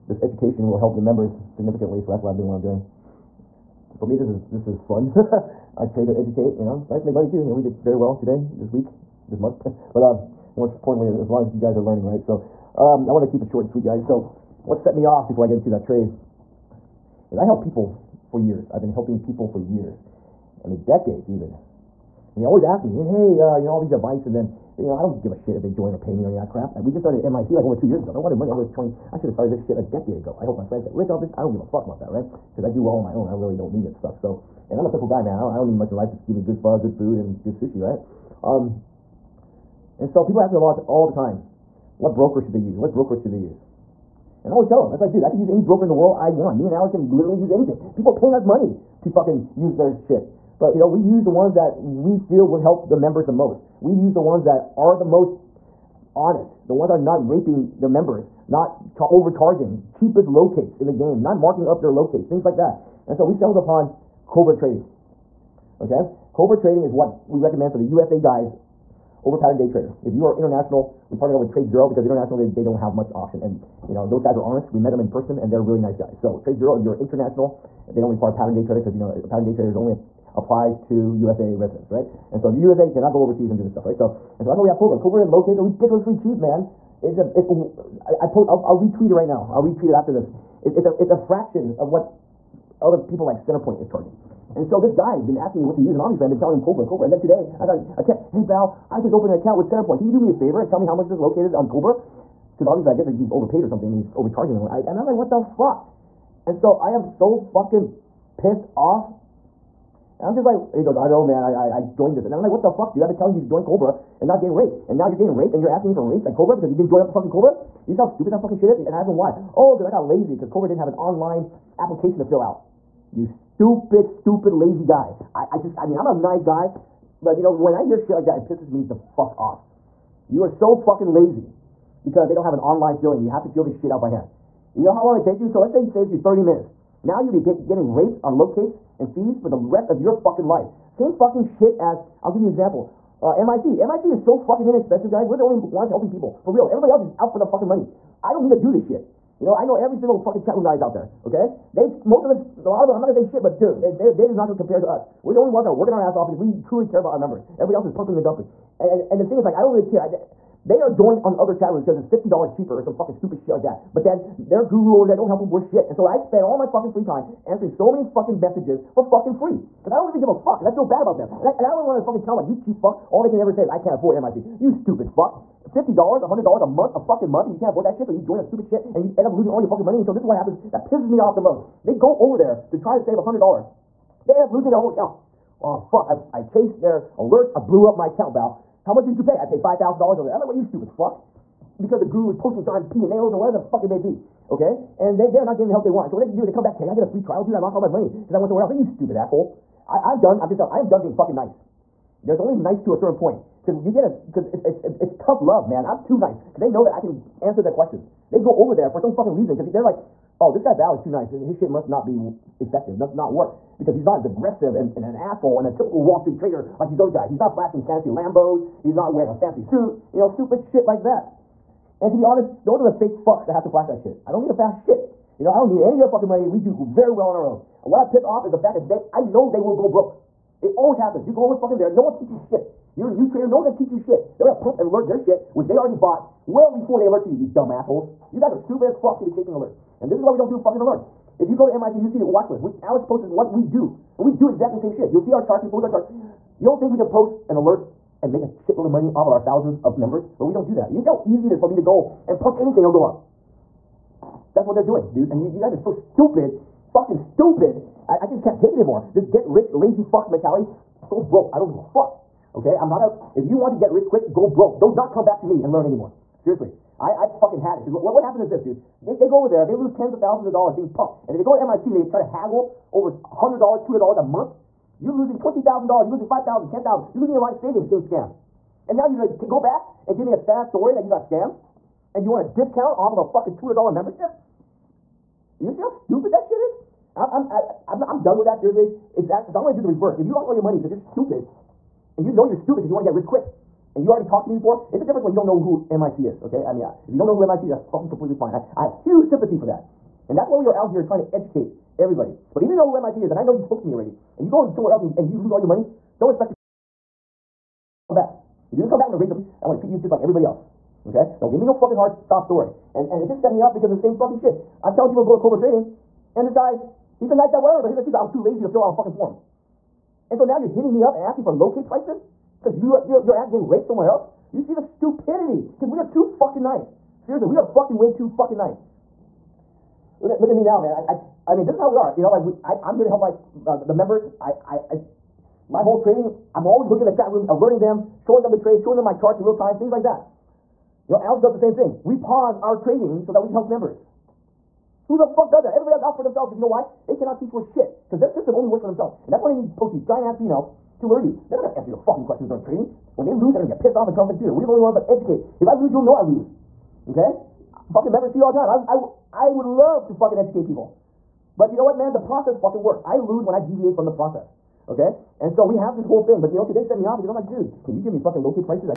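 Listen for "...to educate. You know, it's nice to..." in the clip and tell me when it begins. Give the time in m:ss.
0:06.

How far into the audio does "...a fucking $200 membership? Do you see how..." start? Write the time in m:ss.
4:43.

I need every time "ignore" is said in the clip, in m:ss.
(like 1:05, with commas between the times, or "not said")
not said.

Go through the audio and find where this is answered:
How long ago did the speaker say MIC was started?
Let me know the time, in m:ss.
0:27.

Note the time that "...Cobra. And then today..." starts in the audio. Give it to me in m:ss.
1:36.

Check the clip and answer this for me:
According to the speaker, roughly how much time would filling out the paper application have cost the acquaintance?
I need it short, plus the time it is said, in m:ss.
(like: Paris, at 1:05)
30 minutes, at 2:16.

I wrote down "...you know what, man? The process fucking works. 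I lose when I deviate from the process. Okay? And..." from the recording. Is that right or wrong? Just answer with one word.
right.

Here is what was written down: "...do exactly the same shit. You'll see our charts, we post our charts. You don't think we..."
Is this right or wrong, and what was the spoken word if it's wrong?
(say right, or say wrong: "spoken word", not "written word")
right.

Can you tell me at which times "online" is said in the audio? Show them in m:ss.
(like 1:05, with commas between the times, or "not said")
2:00, 2:12.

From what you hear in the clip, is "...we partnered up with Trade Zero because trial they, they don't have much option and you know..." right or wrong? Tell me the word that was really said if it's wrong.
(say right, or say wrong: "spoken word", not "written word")
wrong: "international", not "trial".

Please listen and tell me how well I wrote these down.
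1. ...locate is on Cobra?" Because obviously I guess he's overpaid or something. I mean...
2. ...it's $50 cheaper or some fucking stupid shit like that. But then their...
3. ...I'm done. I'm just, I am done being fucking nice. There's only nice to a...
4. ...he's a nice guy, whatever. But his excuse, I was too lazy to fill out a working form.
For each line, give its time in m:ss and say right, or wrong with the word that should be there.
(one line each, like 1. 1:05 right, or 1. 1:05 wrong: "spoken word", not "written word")
1. 1:41 right
2. 2:41 right
3. 3:20 right
4. 5:17 wrong: "fucking", not "working".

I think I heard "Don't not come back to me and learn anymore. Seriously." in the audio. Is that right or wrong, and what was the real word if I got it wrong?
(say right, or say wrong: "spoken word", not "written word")
right.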